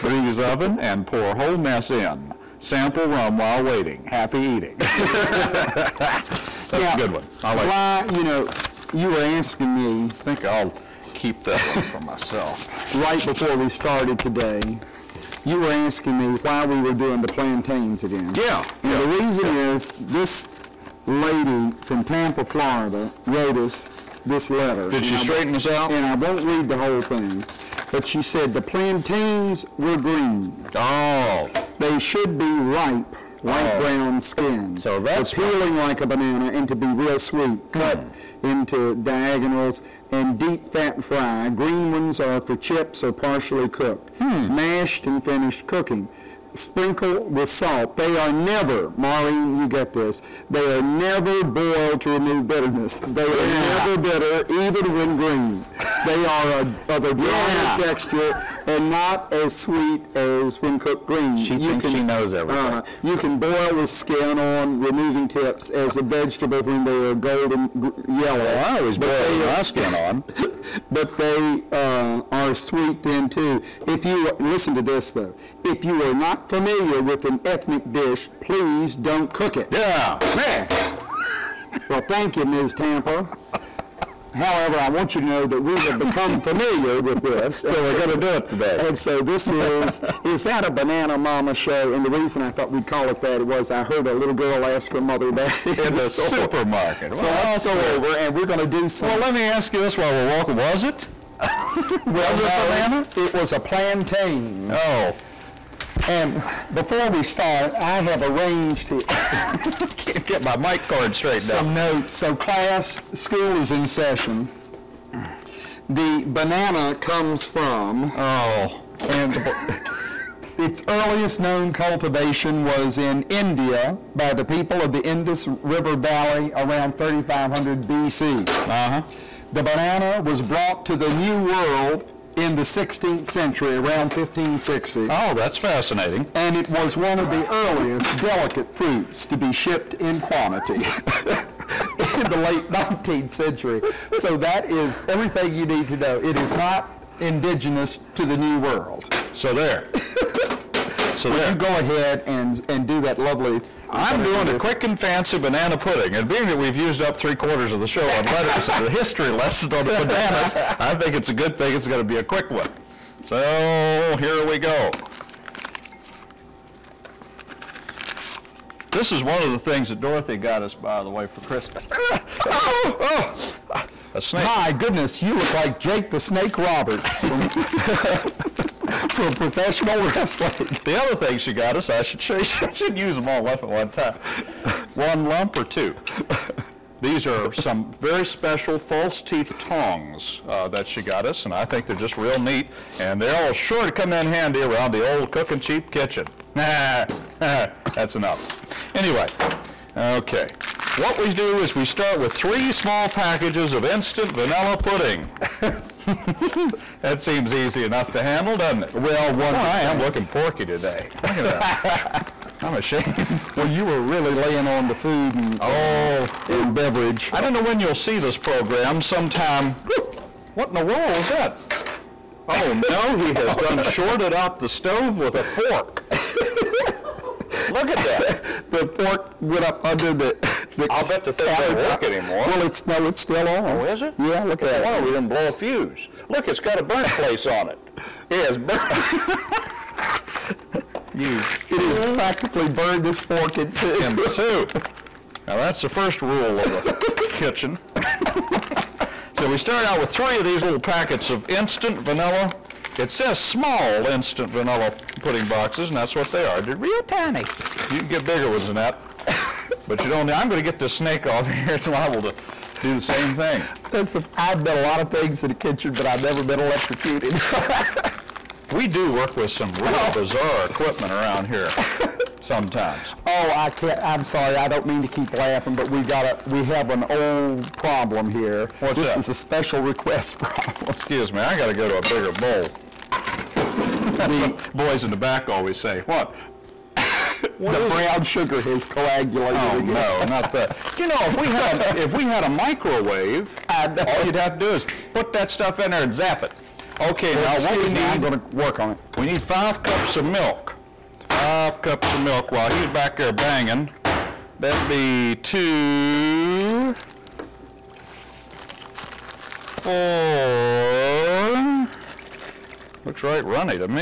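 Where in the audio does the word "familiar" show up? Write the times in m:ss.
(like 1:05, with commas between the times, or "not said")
1:16, 1:26.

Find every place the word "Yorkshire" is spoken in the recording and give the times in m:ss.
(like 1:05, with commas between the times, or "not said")
not said.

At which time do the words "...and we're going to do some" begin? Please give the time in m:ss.
1:38.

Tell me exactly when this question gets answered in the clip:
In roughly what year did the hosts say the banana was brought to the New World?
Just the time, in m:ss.
2:14.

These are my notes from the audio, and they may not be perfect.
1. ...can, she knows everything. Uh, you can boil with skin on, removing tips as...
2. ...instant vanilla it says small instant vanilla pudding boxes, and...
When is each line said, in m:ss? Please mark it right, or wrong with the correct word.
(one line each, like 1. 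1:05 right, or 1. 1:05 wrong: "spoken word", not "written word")
1. 1:01 right
2. 4:11 right.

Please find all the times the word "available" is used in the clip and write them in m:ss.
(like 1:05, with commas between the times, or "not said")
not said.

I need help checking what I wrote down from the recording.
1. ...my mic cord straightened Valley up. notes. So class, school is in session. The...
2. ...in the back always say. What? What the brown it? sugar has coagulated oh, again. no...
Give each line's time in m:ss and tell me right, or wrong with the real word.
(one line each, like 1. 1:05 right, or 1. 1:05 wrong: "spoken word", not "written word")
1. 1:50 wrong: "Some", not "Valley"
2. 4:45 right.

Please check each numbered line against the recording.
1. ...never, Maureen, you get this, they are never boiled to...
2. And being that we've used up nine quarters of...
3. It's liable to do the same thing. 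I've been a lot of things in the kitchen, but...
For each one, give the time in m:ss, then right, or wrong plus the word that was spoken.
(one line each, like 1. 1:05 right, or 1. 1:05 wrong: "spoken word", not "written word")
1. 0:48 right
2. 2:36 wrong: "three", not "nine"
3. 4:21 right.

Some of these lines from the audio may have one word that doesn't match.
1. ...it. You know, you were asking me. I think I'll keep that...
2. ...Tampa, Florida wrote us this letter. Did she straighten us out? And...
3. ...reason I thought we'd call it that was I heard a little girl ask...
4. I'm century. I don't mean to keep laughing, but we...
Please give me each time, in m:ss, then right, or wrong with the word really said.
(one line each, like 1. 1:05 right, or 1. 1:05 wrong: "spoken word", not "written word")
1. 0:08 right
2. 0:22 right
3. 1:32 right
4. 4:34 wrong: "sorry", not "century".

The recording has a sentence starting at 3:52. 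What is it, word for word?
Well, it's no, it's still on.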